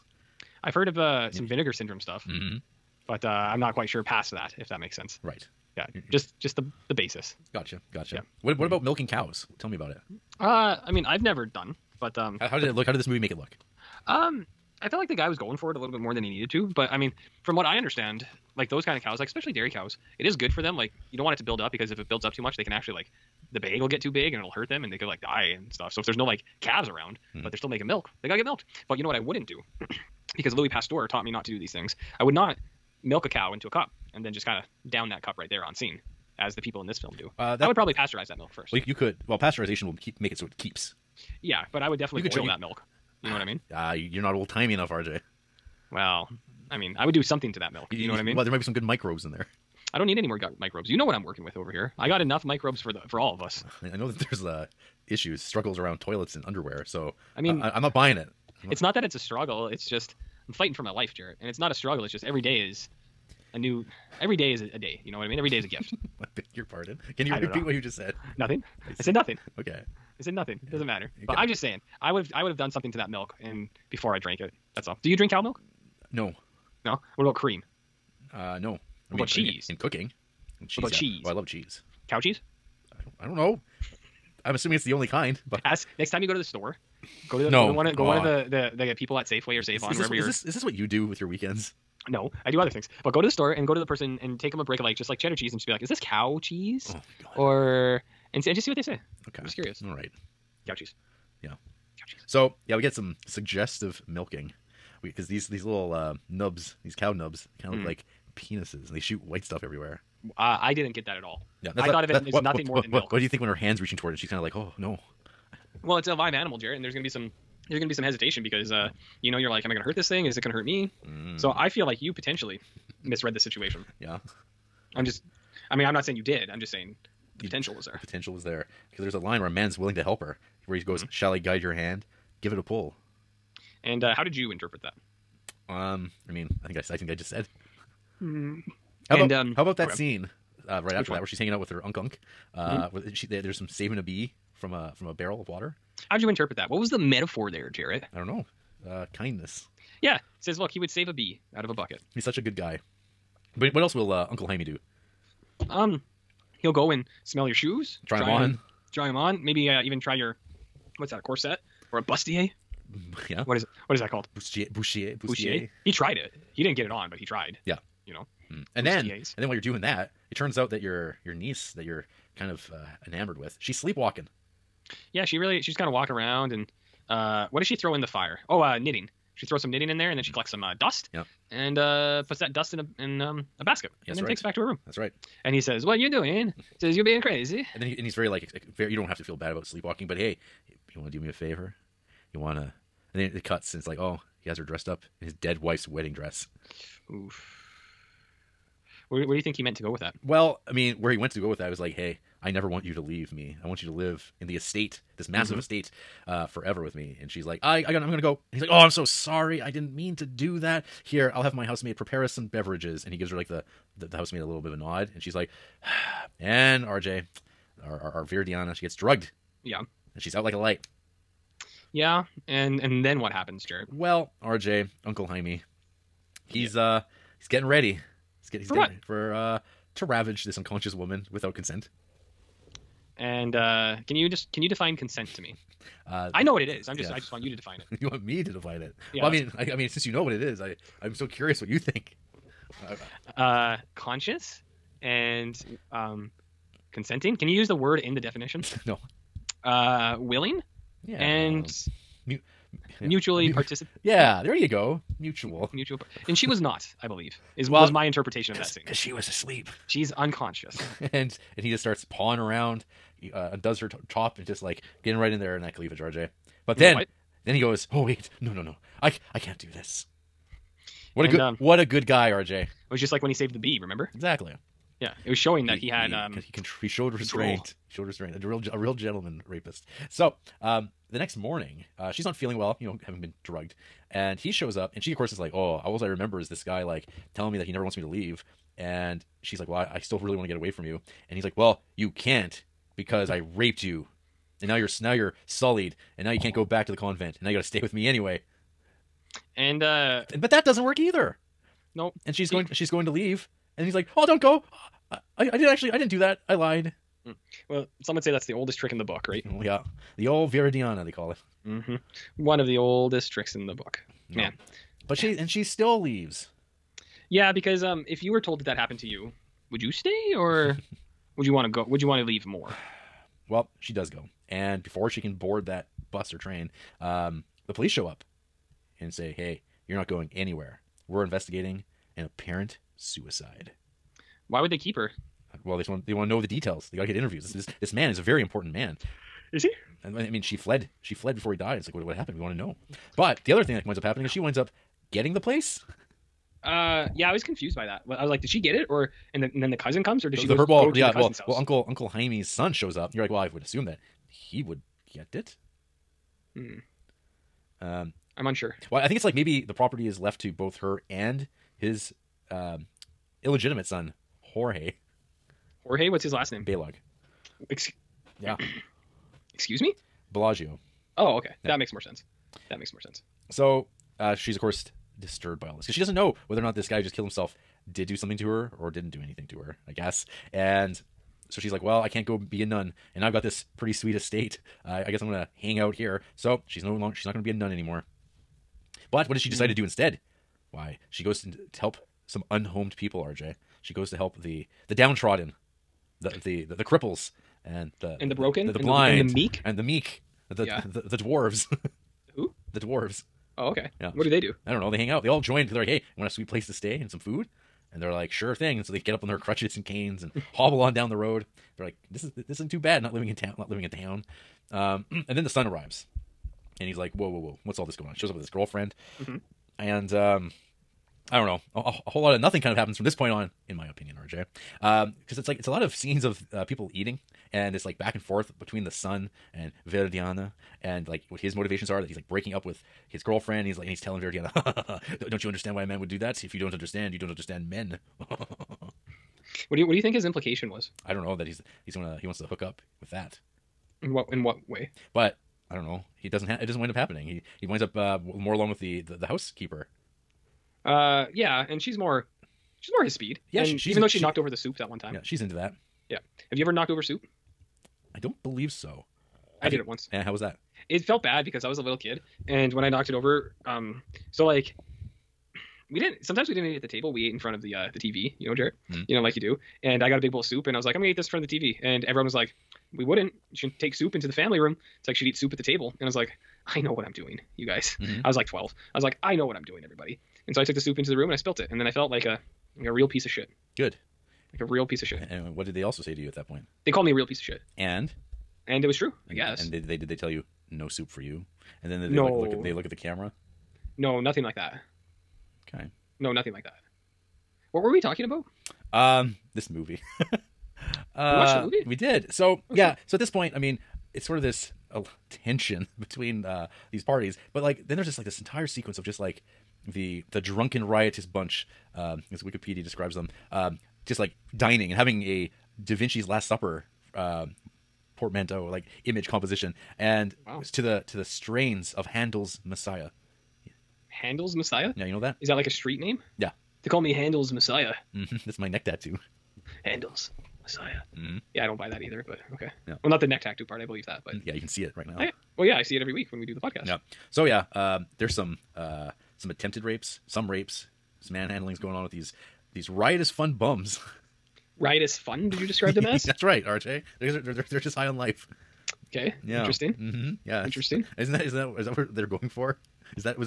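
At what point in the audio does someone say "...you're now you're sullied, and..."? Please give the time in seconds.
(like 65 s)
294 s.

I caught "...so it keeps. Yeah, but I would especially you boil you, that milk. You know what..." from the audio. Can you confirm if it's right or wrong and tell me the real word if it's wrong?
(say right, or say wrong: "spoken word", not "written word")
wrong: "definitely", not "especially".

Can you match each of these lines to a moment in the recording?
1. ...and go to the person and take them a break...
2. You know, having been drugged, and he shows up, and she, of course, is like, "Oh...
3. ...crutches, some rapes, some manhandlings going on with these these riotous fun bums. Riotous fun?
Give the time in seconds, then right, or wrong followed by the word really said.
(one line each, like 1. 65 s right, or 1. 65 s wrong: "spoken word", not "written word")
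1. 93 s right
2. 282 s right
3. 539 s wrong: "rapes", not "crutches".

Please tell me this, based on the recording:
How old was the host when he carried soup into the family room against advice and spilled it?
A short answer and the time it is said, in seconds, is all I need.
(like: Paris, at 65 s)
12, at 478 s.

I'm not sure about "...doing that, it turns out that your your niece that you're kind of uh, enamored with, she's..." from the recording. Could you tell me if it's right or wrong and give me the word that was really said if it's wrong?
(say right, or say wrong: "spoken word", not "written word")
right.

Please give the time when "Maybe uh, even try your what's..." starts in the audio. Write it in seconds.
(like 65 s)
159 s.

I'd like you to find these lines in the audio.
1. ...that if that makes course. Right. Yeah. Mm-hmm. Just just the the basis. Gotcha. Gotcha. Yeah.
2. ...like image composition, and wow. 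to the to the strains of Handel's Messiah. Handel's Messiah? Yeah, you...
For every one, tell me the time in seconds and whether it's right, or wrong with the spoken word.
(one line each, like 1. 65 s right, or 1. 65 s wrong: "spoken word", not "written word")
1. 4 s wrong: "sense", not "course"
2. 518 s right.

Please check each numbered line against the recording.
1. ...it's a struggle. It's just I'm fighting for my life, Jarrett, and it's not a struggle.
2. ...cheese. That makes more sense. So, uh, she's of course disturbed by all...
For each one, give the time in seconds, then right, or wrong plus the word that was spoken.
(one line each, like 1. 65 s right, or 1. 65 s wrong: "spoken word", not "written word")
1. 59 s right
2. 371 s wrong: "sense", not "cheese".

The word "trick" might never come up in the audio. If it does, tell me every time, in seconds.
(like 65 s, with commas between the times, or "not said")
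308 s, 313 s.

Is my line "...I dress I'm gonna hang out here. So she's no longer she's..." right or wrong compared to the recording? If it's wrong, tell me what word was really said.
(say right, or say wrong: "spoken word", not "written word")
wrong: "guess", not "dress".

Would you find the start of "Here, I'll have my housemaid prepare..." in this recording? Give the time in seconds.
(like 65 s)
211 s.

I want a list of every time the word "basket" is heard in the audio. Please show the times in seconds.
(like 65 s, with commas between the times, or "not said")
183 s.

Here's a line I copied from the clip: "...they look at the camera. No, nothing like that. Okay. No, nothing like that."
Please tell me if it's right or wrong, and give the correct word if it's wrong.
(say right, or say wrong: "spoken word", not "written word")
right.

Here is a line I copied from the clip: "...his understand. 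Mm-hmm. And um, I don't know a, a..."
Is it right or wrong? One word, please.
wrong.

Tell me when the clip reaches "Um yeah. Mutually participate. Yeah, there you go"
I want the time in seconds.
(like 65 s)
251 s.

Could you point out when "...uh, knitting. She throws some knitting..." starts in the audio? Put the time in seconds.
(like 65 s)
178 s.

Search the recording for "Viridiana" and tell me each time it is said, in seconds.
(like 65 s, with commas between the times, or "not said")
310 s, 429 s, 434 s.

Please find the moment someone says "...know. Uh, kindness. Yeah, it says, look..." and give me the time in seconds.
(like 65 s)
148 s.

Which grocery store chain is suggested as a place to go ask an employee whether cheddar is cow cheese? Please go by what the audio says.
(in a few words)
Safeway.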